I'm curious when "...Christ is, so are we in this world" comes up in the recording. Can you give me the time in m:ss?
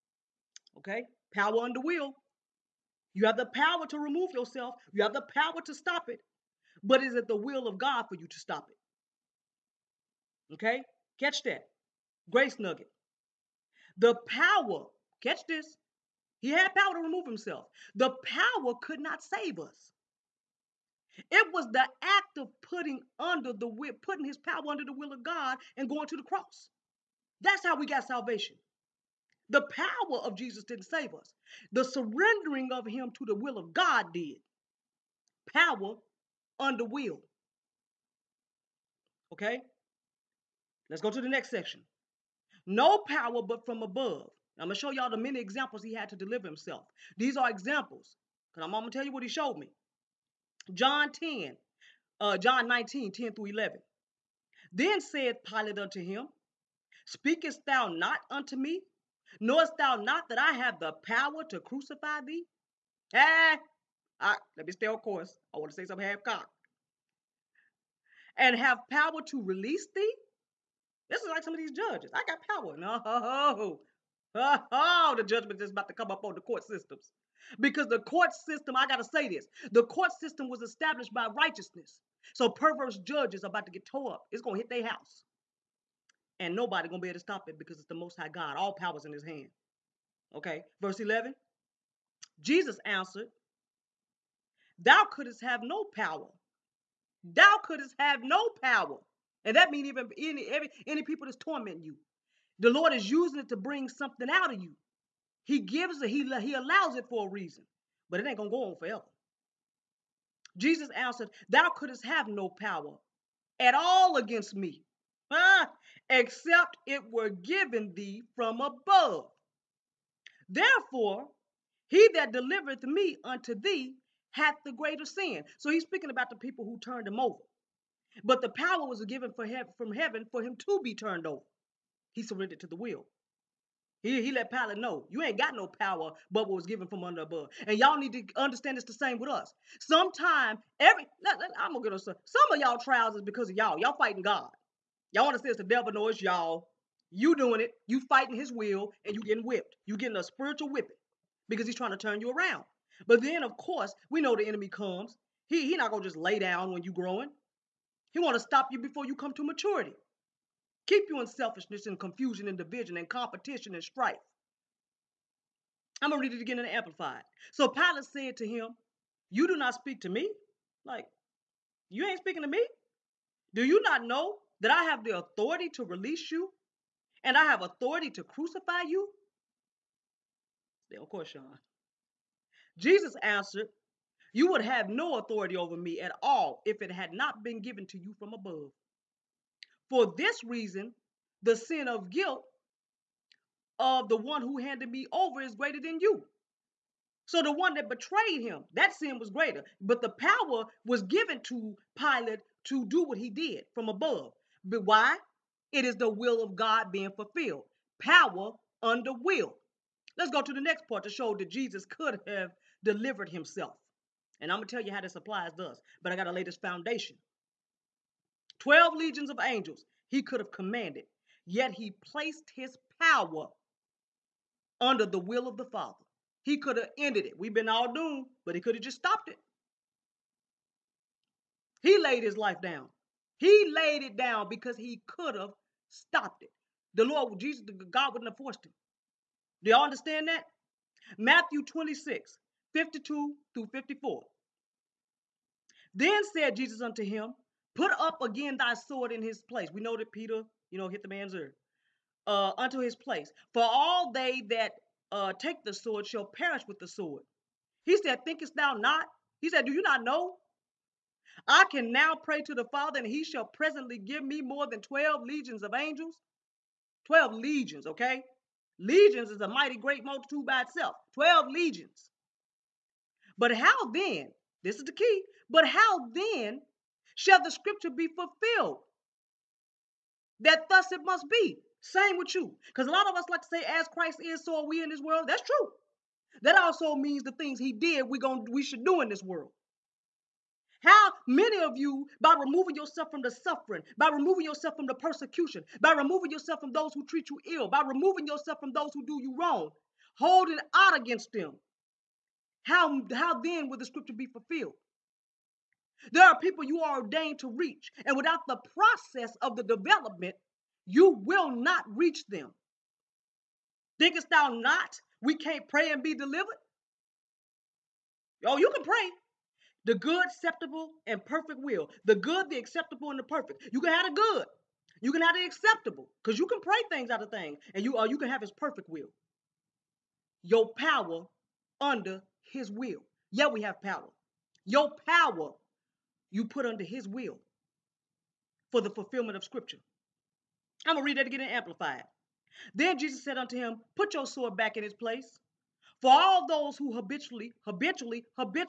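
4:43.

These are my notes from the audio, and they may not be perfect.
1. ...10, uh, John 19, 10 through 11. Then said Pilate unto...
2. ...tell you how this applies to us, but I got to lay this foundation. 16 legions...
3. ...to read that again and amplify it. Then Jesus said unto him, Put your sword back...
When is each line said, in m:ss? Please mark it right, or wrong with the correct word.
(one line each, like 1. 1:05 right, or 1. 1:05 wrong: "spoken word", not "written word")
1. 0:51 right
2. 3:34 wrong: "12", not "16"
3. 5:41 right.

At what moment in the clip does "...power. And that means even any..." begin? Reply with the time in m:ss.
1:38.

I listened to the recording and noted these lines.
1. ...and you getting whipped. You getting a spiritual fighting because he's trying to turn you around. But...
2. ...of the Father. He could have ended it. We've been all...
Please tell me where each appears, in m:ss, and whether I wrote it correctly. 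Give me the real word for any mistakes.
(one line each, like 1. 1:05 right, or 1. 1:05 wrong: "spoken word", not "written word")
1. 2:29 wrong: "whipping", not "fighting"
2. 3:45 right.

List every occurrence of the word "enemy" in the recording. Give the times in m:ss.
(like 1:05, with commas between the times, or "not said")
2:34.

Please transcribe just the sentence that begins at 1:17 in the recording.
Because the court system, I got to say this, the court system was established by righteousness.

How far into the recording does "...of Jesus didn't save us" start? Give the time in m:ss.
0:30.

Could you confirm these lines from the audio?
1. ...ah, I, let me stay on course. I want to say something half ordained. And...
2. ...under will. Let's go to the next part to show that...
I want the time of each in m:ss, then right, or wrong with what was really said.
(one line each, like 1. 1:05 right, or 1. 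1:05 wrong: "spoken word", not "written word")
1. 1:03 wrong: "cocked", not "ordained"
2. 3:28 right.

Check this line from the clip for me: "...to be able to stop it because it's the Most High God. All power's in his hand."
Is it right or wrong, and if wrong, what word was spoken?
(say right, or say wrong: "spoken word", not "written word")
right.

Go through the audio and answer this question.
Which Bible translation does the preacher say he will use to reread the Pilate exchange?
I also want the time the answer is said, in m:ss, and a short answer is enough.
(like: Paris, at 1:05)
Amplified, at 2:46.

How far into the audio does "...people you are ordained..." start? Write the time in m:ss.
5:06.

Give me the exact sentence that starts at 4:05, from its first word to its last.
Then said Jesus unto him, Put up again thy sword in his place.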